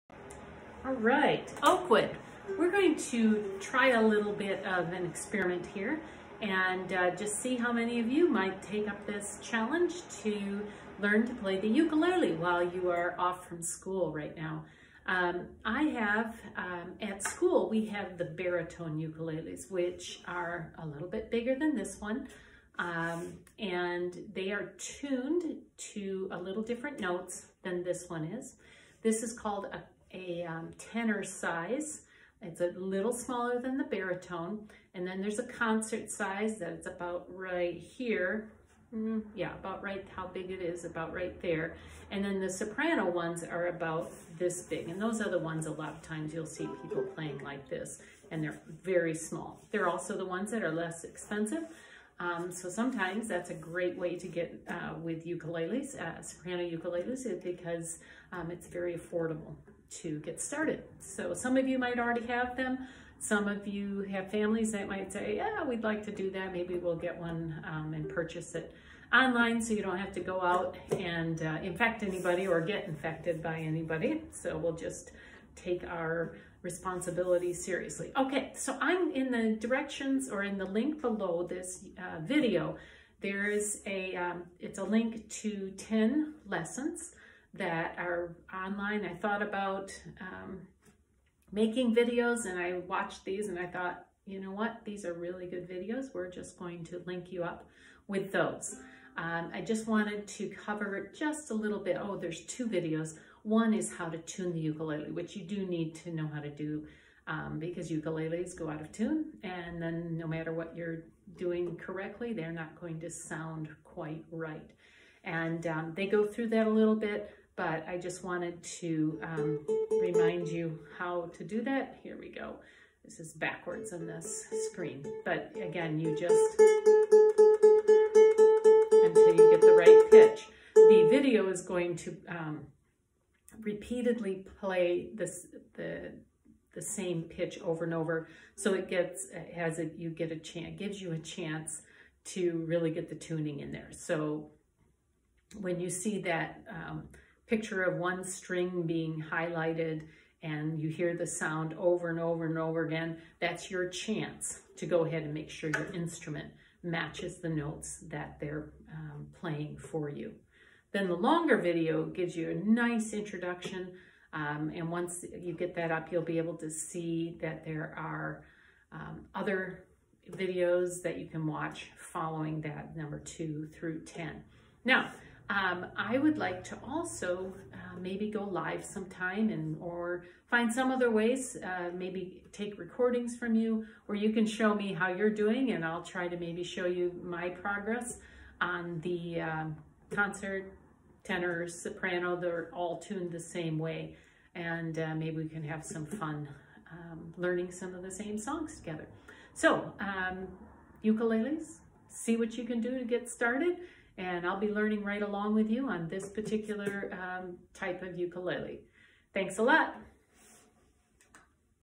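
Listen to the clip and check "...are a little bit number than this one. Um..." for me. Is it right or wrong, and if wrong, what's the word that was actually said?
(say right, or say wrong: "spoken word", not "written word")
wrong: "bigger", not "number".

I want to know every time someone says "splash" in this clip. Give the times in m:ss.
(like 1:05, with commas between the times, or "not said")
not said.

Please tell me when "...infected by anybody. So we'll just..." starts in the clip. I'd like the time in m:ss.
1:12.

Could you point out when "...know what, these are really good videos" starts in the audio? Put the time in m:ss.
1:34.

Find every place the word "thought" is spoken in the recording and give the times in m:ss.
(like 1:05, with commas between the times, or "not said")
1:29, 1:33.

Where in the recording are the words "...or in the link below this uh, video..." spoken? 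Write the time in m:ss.
1:20.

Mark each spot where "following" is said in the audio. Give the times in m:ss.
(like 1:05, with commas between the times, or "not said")
2:52.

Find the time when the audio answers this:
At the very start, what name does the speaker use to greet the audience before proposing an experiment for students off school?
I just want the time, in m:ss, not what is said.
0:01.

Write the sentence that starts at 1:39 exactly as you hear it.
Um, I just wanted to cover just a little bit.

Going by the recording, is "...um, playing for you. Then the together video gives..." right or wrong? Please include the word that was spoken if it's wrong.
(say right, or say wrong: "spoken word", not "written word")
wrong: "longer", not "together".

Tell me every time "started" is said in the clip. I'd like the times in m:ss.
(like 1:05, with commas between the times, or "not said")
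1:00, 3:23.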